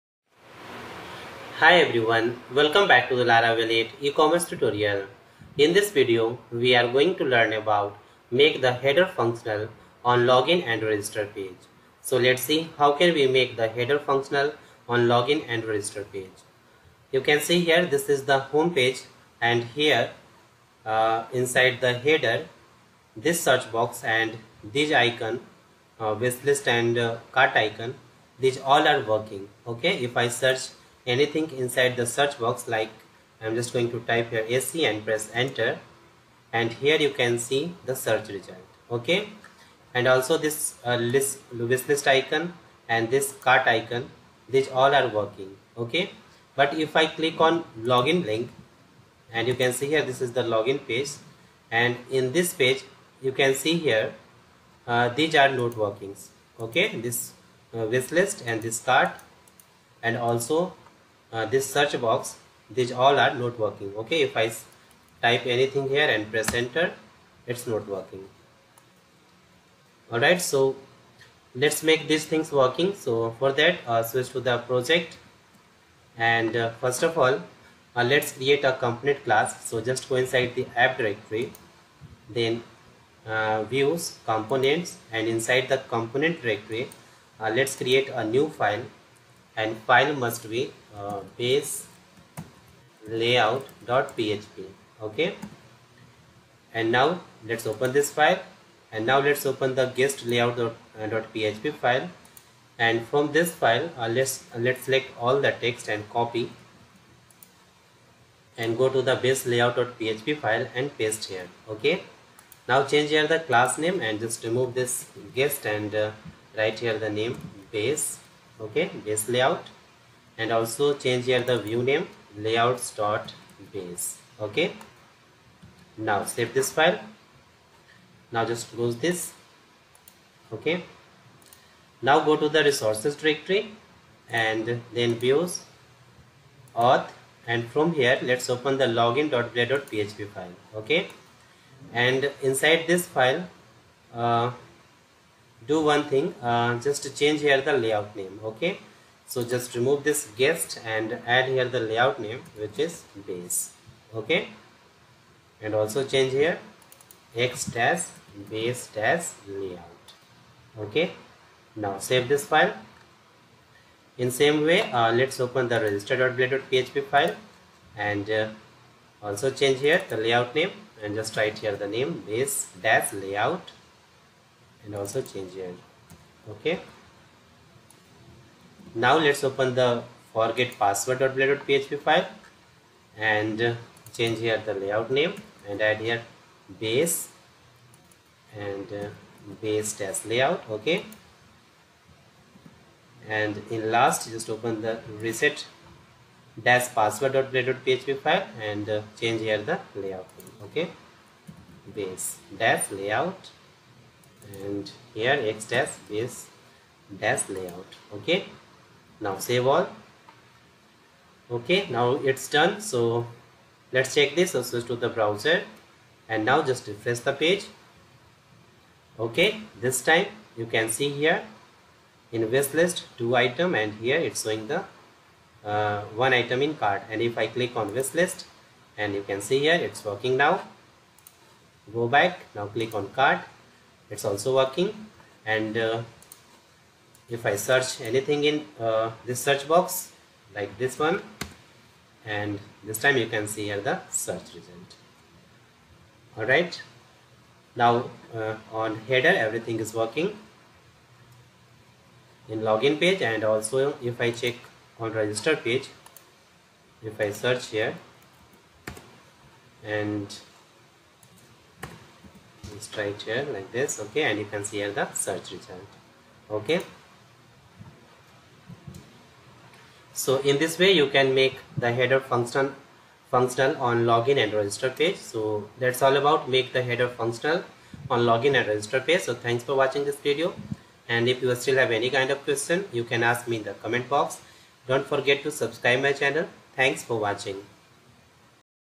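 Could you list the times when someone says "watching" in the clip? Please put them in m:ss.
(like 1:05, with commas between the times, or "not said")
4:39, 4:47.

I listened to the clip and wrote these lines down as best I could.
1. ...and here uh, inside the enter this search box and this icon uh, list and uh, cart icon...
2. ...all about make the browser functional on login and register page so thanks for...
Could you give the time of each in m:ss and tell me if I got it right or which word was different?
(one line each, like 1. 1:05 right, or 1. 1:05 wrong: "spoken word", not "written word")
1. 0:19 wrong: "header", not "enter"
2. 4:36 wrong: "header", not "browser".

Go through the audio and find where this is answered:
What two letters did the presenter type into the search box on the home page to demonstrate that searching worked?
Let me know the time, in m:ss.
0:34.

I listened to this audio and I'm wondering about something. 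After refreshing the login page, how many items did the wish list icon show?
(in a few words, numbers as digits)
2.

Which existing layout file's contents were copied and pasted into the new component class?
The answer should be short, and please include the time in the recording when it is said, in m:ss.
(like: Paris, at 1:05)
guest layout.php, at 1:39.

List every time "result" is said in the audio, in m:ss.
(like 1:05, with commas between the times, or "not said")
0:38, 4:04, 4:25.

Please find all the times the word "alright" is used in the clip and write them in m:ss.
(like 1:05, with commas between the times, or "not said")
1:10, 4:06.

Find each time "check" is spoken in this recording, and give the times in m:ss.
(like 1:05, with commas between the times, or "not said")
3:34, 4:14.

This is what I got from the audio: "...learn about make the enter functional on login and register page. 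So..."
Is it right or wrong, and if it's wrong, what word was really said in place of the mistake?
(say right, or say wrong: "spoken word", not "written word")
wrong: "header", not "enter".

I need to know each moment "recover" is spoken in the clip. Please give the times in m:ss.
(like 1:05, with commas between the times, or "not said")
not said.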